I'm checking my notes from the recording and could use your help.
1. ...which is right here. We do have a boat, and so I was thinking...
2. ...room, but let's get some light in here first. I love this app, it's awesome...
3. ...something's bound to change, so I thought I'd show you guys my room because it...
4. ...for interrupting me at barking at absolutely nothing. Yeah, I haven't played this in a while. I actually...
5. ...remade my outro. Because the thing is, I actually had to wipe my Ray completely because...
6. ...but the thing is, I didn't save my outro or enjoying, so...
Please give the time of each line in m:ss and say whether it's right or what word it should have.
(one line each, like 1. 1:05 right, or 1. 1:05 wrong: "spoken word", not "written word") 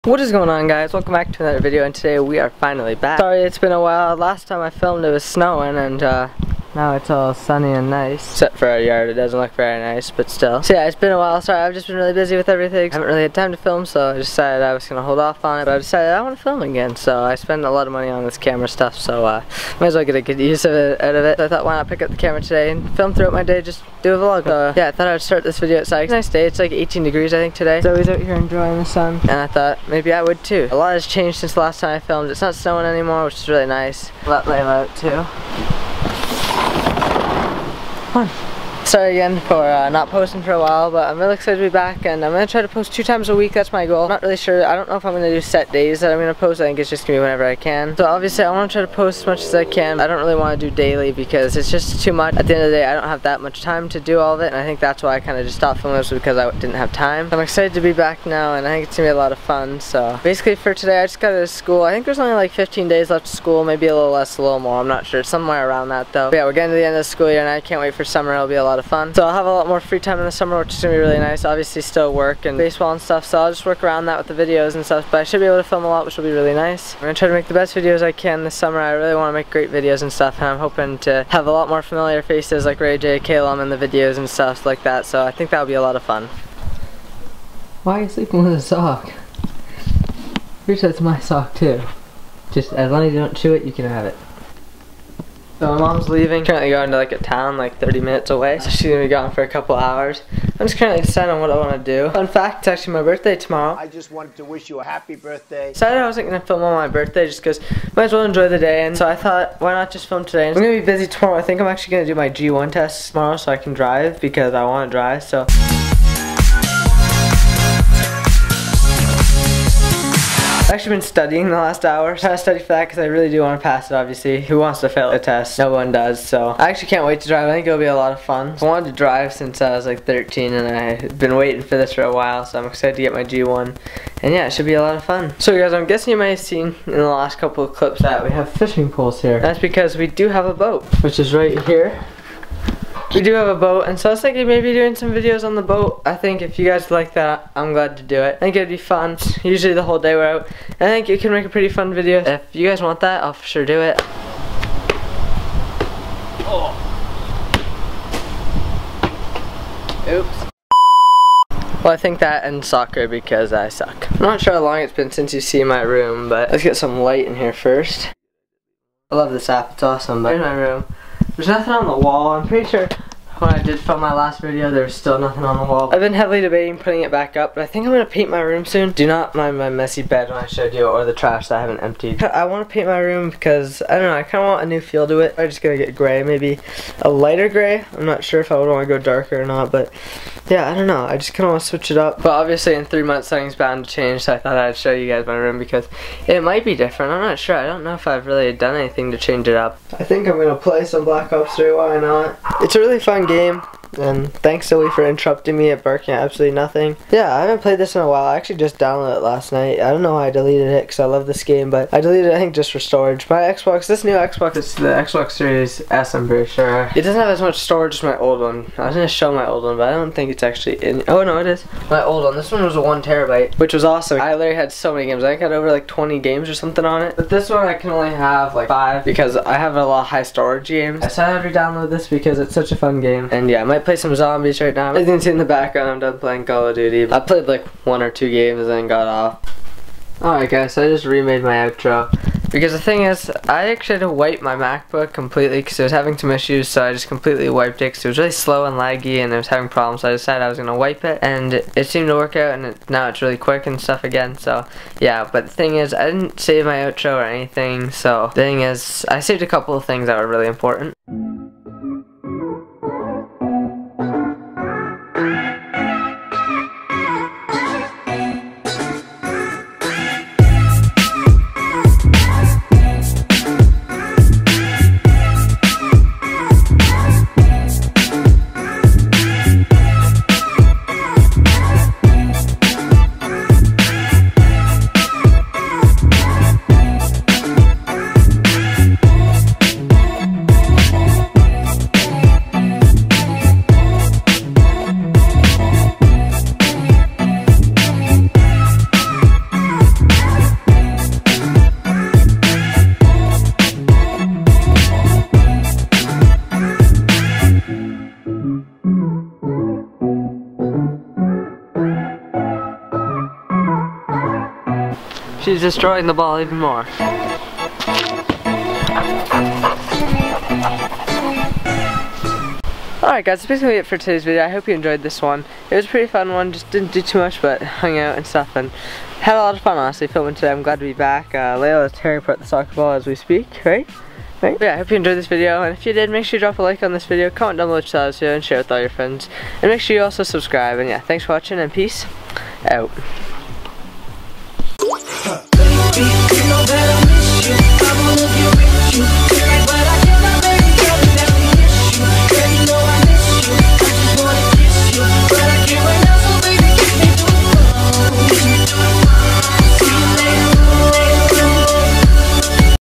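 1. 2:21 right
2. 2:45 right
3. 3:13 right
4. 3:24 right
5. 4:01 wrong: "MacBook", not "Ray"
6. 4:15 wrong: "anything", not "enjoying".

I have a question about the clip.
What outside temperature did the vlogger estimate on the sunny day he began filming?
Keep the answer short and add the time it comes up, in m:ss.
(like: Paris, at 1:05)
18 degrees, at 0:26.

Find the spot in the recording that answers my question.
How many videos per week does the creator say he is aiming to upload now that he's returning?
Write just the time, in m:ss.
0:42.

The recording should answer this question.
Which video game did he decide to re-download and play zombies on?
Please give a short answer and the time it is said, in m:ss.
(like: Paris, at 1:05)
Black Ops 3, at 3:21.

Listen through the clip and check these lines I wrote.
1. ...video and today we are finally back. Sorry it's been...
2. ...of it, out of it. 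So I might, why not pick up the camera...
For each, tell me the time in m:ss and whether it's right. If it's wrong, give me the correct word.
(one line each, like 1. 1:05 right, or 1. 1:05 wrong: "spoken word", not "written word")
1. 0:01 right
2. 0:20 wrong: "thought", not "might".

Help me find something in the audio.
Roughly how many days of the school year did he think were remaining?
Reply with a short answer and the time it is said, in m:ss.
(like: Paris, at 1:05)
15, at 1:02.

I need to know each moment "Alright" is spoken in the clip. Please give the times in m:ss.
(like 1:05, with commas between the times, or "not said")
4:00, 5:23.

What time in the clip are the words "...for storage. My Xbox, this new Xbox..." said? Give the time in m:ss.
3:32.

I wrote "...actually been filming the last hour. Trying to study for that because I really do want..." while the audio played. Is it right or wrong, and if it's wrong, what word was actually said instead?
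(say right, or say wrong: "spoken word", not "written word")
wrong: "studying", not "filming".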